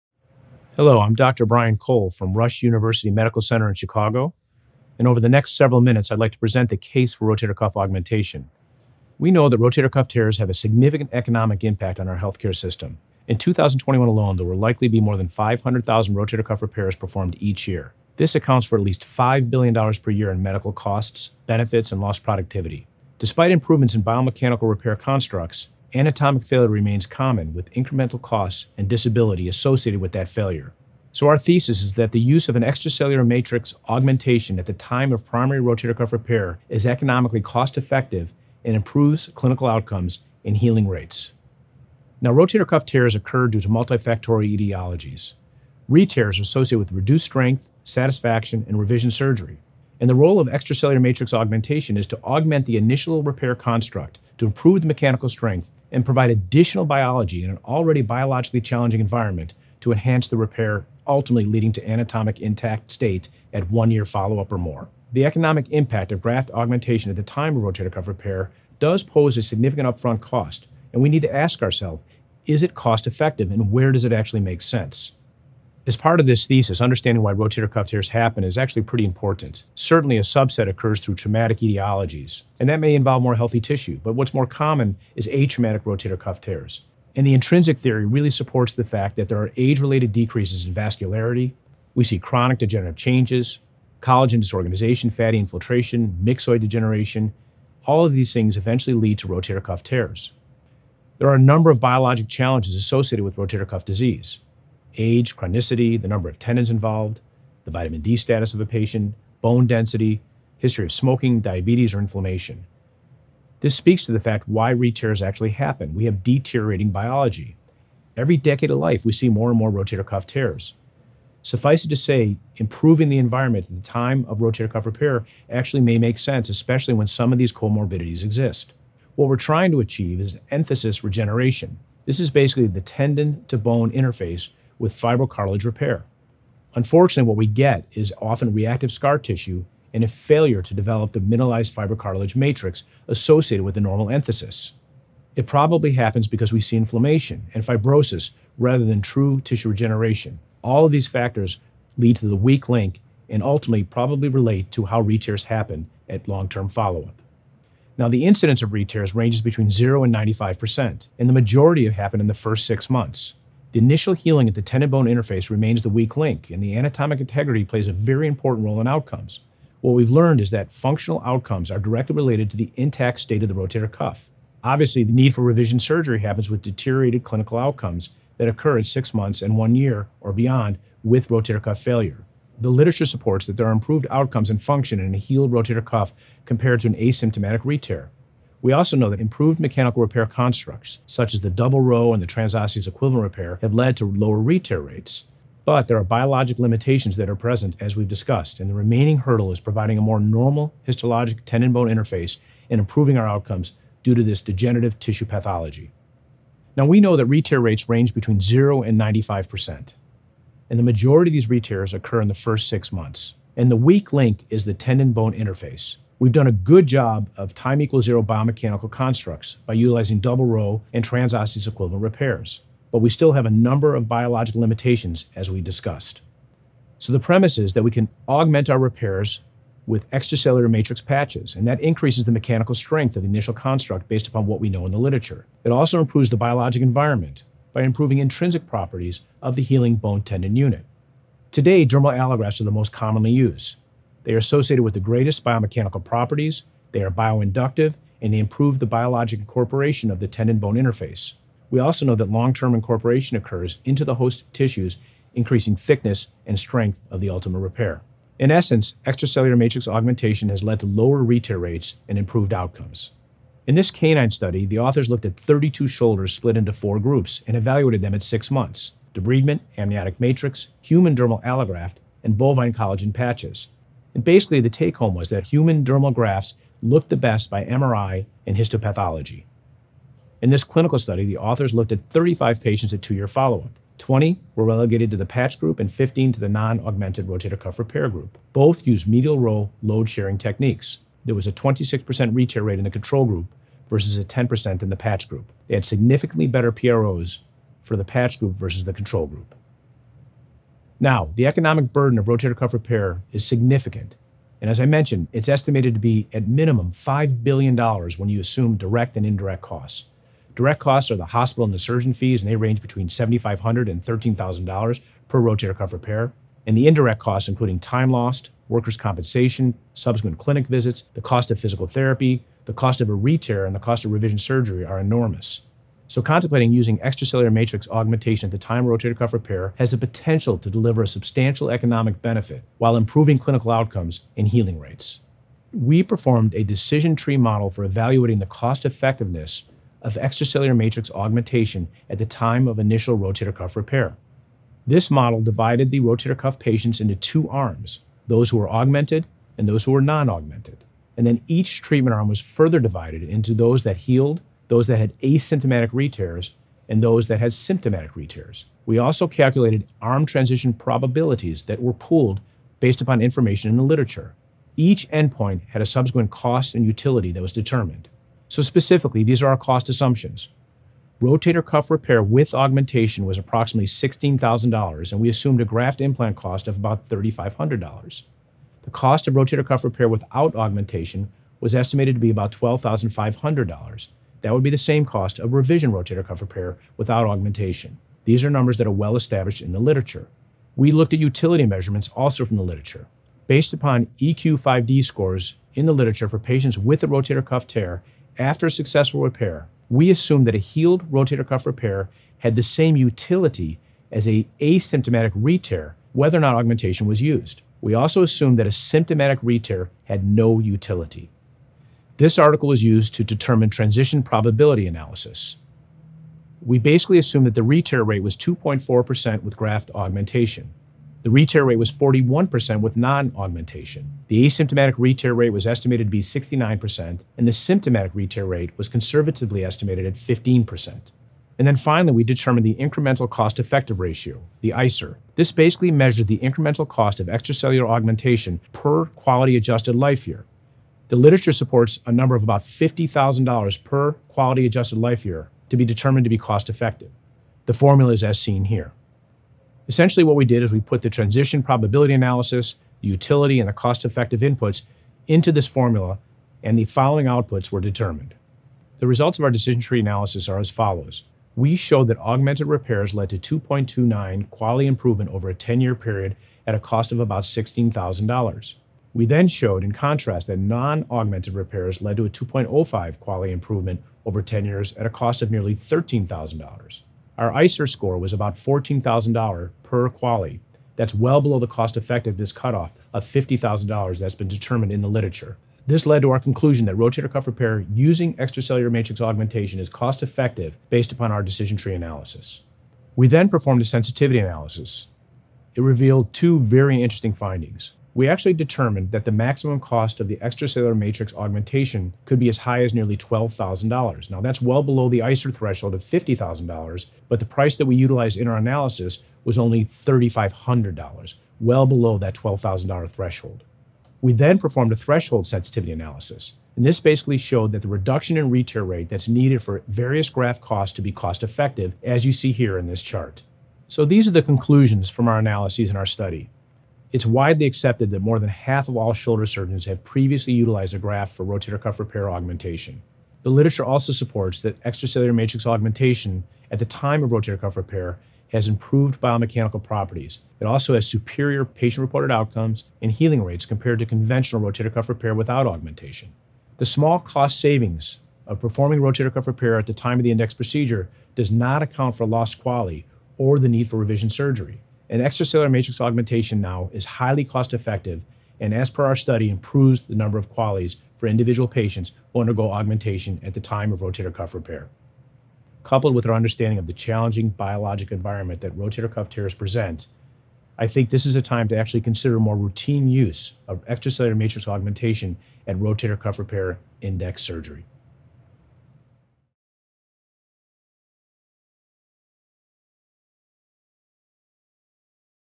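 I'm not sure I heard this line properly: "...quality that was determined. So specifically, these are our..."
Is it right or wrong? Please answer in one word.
wrong.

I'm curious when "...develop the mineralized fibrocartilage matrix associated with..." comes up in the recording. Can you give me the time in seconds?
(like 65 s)
140 s.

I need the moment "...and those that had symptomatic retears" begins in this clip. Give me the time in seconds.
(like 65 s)
356 s.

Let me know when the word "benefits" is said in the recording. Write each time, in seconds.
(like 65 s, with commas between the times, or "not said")
21 s, 332 s.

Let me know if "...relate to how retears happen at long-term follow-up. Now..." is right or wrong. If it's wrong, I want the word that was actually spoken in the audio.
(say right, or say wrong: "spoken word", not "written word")
right.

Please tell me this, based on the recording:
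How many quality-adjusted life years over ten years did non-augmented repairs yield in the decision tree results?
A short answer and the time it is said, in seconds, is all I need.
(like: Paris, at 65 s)
2.05, at 472 s.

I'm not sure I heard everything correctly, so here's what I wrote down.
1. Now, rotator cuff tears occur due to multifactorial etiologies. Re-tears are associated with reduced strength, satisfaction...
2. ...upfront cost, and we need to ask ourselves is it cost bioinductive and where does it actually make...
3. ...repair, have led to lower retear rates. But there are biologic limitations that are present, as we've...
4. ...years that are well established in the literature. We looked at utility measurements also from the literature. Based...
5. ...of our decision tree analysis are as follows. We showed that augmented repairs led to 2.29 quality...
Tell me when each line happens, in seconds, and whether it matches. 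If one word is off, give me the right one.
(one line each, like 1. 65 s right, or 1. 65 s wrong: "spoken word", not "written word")
1. 42 s right
2. 69 s wrong: "effective", not "bioinductive"
3. 193 s right
4. 388 s wrong: "numbers", not "years"
5. 459 s right.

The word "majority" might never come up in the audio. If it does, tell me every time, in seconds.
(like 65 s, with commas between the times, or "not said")
161 s, 210 s.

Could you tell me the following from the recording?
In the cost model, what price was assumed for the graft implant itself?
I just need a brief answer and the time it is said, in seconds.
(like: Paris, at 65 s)
$3,500, at 376 s.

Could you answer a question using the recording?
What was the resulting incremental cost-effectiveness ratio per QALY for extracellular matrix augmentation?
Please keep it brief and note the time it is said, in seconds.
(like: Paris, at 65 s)
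about $14,000, at 478 s.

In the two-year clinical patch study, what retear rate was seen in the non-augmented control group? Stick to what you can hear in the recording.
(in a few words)
26%.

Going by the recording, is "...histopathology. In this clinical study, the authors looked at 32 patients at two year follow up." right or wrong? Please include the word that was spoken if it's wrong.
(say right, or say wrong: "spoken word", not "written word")
wrong: "35", not "32".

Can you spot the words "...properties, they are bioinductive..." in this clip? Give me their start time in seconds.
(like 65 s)
246 s.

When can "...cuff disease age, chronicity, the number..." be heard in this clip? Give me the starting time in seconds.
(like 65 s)
103 s.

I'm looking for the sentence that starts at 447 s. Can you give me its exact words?
The formula is as seen here.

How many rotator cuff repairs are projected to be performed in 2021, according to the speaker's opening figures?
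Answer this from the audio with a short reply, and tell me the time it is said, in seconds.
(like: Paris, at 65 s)
more than 500,000, at 15 s.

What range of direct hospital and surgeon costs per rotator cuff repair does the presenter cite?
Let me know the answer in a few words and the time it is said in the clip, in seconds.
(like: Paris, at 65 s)
$7,500 to $13,000, at 312 s.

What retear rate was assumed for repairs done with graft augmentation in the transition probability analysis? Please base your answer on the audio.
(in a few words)
2.4%.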